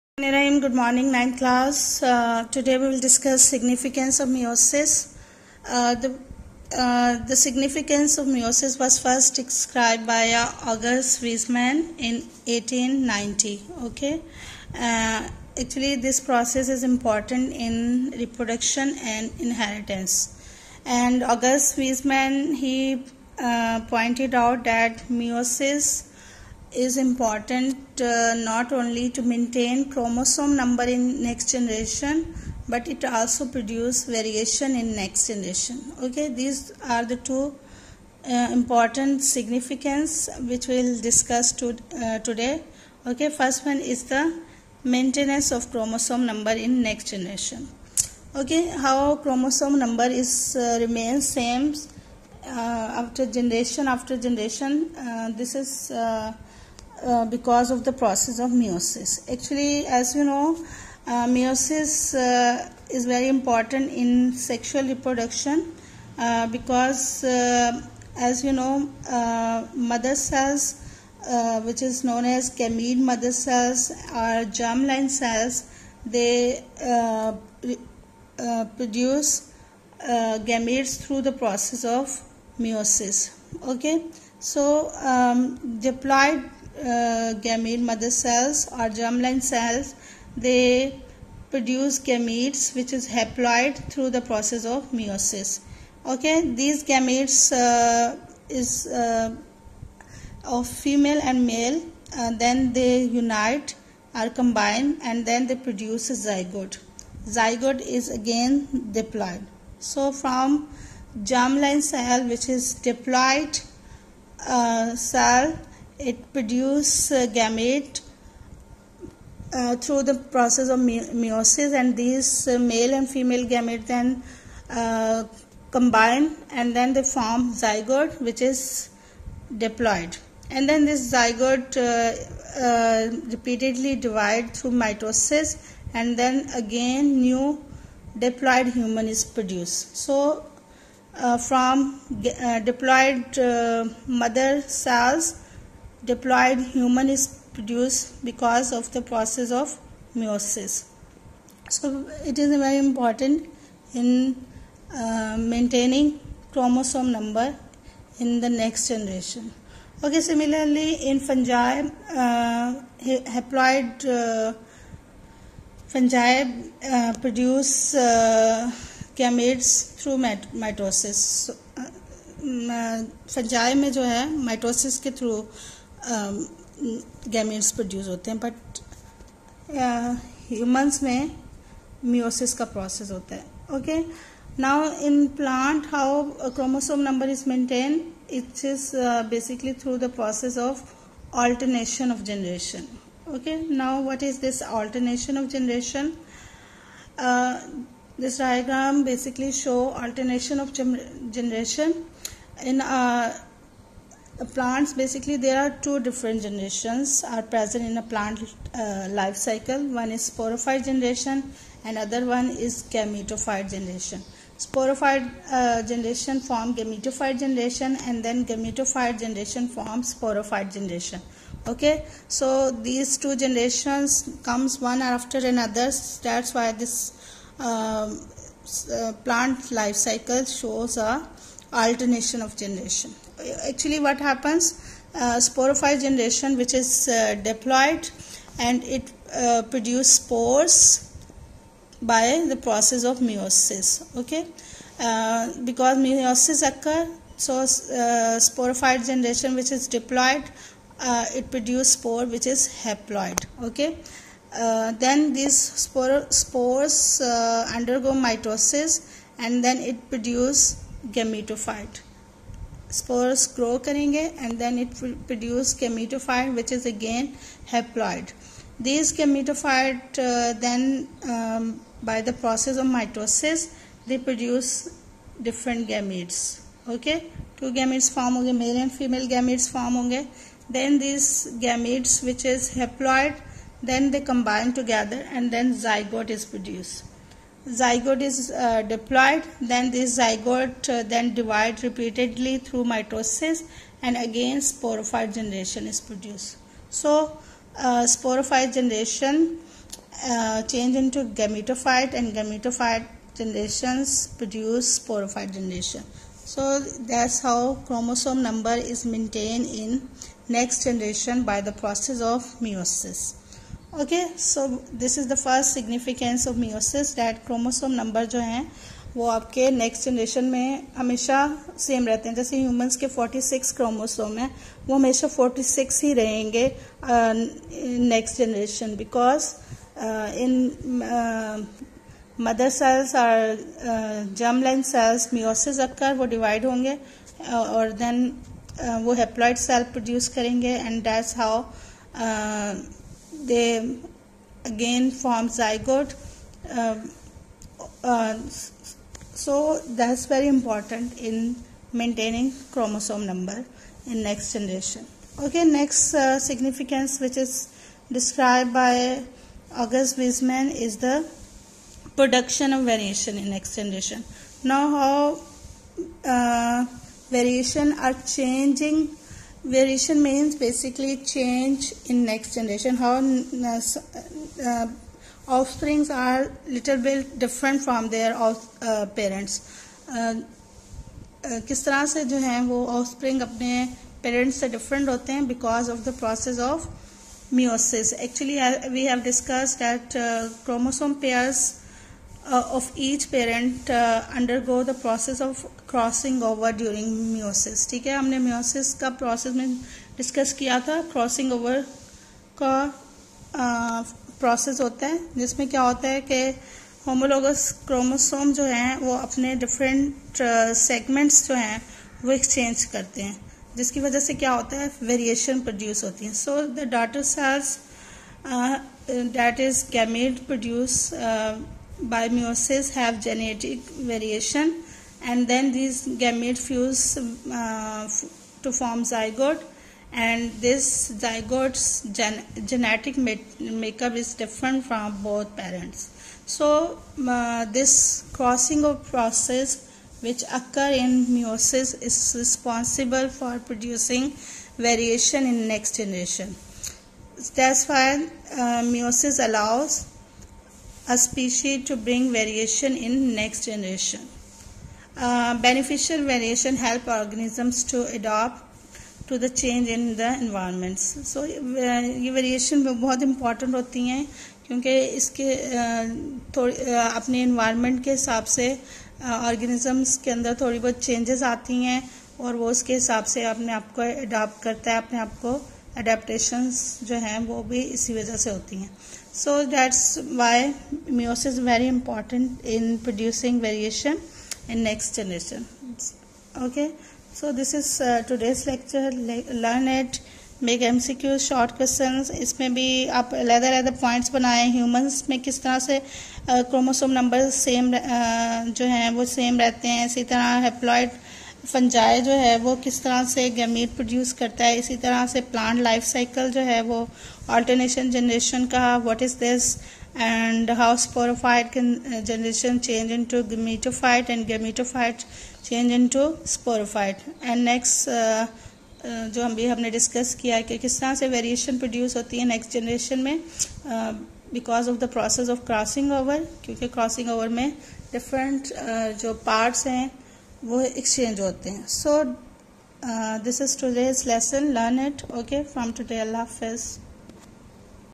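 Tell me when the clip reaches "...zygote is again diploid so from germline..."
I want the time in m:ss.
1:47.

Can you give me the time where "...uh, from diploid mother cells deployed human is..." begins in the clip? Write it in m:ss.
2:21.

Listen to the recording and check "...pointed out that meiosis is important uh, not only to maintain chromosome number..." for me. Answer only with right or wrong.
right.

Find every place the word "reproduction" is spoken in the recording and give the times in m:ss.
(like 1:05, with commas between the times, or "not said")
0:18, 1:04.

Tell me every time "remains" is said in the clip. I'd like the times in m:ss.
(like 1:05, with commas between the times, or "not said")
0:50.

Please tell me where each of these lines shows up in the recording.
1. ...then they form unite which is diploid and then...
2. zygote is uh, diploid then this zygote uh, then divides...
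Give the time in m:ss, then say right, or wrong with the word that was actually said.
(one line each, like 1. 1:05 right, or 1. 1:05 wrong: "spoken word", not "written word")
1. 2:06 wrong: "zygote", not "unite"
2. 4:47 right.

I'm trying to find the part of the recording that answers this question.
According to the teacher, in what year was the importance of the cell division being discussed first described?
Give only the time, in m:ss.
0:12.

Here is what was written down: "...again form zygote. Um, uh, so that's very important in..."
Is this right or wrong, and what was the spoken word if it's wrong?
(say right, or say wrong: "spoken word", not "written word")
right.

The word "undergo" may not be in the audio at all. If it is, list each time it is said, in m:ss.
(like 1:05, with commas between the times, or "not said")
4:17, 6:34.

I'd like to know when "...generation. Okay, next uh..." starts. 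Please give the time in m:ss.
5:54.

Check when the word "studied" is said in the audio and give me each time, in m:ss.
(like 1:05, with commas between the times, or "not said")
not said.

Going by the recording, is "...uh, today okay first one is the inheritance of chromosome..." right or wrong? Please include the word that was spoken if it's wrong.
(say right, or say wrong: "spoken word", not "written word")
wrong: "maintenance", not "inheritance".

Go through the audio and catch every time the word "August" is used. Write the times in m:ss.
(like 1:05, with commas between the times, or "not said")
0:10, 0:21, 5:59.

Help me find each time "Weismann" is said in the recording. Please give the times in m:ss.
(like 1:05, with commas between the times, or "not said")
0:11, 0:21, 6:00.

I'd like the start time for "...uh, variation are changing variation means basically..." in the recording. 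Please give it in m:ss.
6:06.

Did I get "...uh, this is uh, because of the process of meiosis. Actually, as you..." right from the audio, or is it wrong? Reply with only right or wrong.
right.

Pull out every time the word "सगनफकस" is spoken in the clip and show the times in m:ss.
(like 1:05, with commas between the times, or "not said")
5:15.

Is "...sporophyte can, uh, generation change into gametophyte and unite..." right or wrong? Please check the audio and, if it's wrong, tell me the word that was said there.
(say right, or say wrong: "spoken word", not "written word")
wrong: "gametophyte", not "unite".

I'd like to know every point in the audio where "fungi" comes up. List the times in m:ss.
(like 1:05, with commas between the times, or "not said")
2:41, 2:45, 2:53.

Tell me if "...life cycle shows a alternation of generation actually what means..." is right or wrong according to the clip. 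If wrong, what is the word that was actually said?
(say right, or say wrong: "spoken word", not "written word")
wrong: "happens", not "means".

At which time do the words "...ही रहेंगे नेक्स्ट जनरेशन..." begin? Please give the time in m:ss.
5:26.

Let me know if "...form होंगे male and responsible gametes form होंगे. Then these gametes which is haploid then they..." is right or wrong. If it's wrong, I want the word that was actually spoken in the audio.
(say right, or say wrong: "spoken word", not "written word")
wrong: "female", not "responsible".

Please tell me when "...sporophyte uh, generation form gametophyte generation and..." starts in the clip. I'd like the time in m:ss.
3:34.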